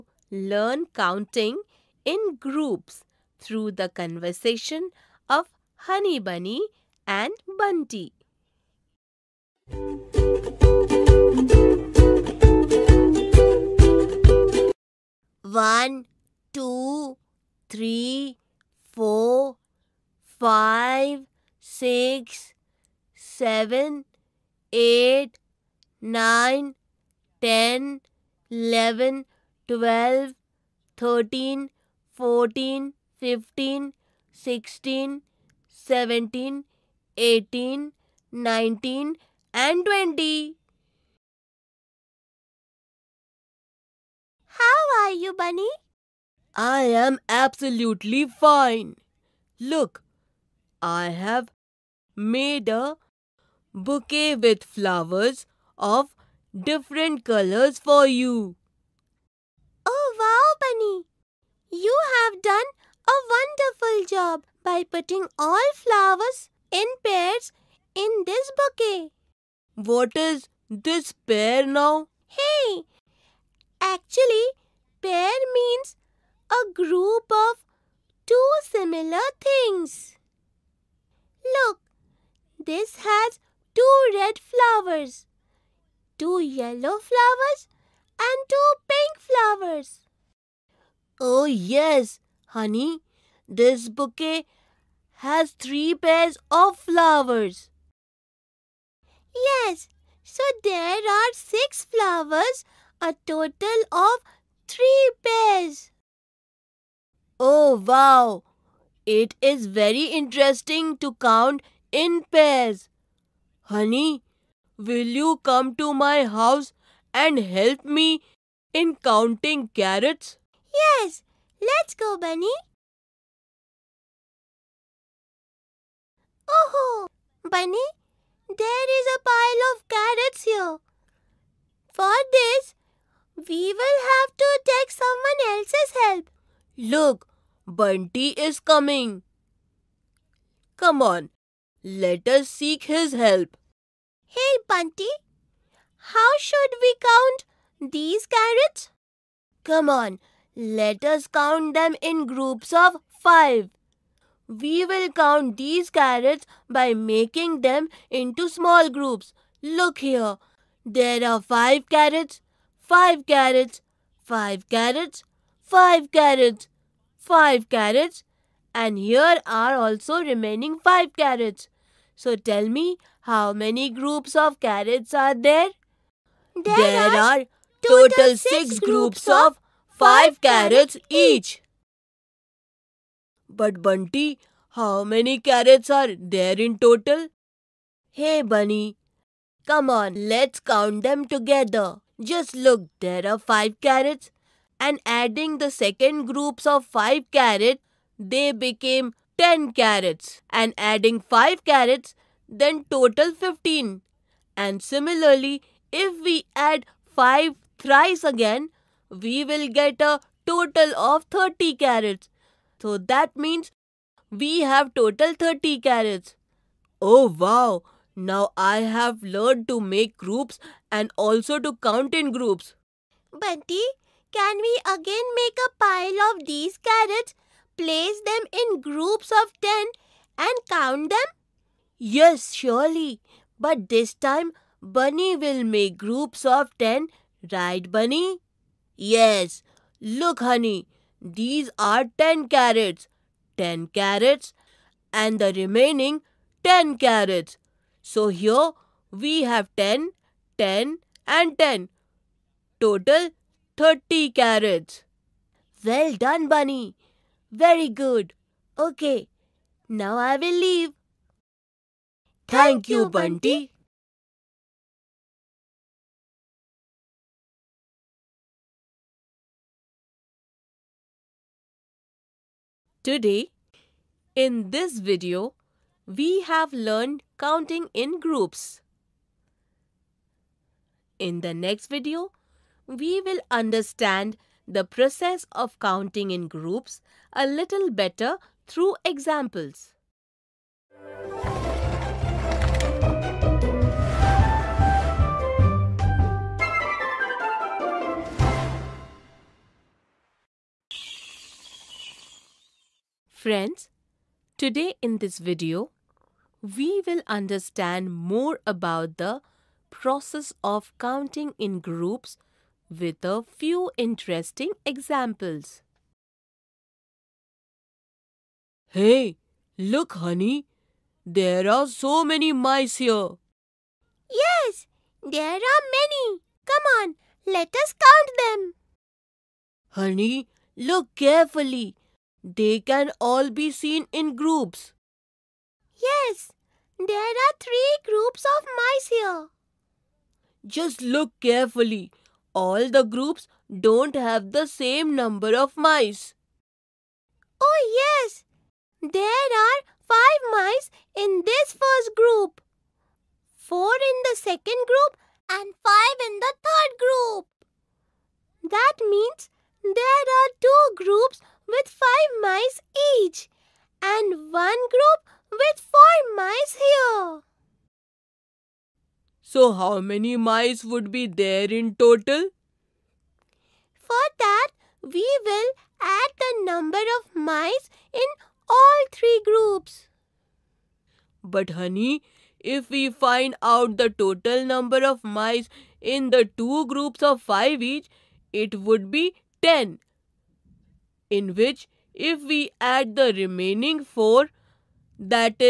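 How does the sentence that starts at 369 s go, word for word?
So how many mice would be there in total?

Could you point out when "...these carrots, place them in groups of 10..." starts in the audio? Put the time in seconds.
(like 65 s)
226 s.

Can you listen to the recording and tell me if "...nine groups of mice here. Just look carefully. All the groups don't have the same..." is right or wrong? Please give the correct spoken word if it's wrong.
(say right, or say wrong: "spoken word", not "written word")
wrong: "three", not "nine".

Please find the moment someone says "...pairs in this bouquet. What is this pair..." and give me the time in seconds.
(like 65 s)
67 s.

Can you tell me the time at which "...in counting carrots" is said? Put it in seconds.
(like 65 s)
118 s.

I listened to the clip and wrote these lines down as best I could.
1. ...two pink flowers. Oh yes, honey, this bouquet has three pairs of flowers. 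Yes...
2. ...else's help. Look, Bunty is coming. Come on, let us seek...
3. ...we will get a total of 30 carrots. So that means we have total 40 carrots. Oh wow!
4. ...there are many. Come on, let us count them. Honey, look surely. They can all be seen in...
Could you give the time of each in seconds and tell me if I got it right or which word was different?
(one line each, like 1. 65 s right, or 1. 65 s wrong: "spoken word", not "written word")
1. 88 s right
2. 135 s right
3. 209 s wrong: "30", not "40"
4. 325 s wrong: "carefully", not "surely".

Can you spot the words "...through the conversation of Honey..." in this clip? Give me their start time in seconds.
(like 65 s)
3 s.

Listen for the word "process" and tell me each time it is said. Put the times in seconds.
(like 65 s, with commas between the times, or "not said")
284 s, 310 s.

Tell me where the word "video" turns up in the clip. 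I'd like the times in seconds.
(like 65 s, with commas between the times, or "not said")
274 s, 281 s, 305 s.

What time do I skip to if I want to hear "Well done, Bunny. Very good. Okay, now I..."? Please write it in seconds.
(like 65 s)
255 s.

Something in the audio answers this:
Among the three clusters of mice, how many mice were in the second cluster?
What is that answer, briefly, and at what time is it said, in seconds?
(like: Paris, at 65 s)
4, at 353 s.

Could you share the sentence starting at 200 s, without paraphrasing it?
And adding 5 carrots, then total 15.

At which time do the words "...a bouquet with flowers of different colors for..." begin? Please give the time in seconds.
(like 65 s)
52 s.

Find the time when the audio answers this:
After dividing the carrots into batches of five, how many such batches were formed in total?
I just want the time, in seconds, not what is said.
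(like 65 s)
178 s.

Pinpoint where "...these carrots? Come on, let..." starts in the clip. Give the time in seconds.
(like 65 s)
147 s.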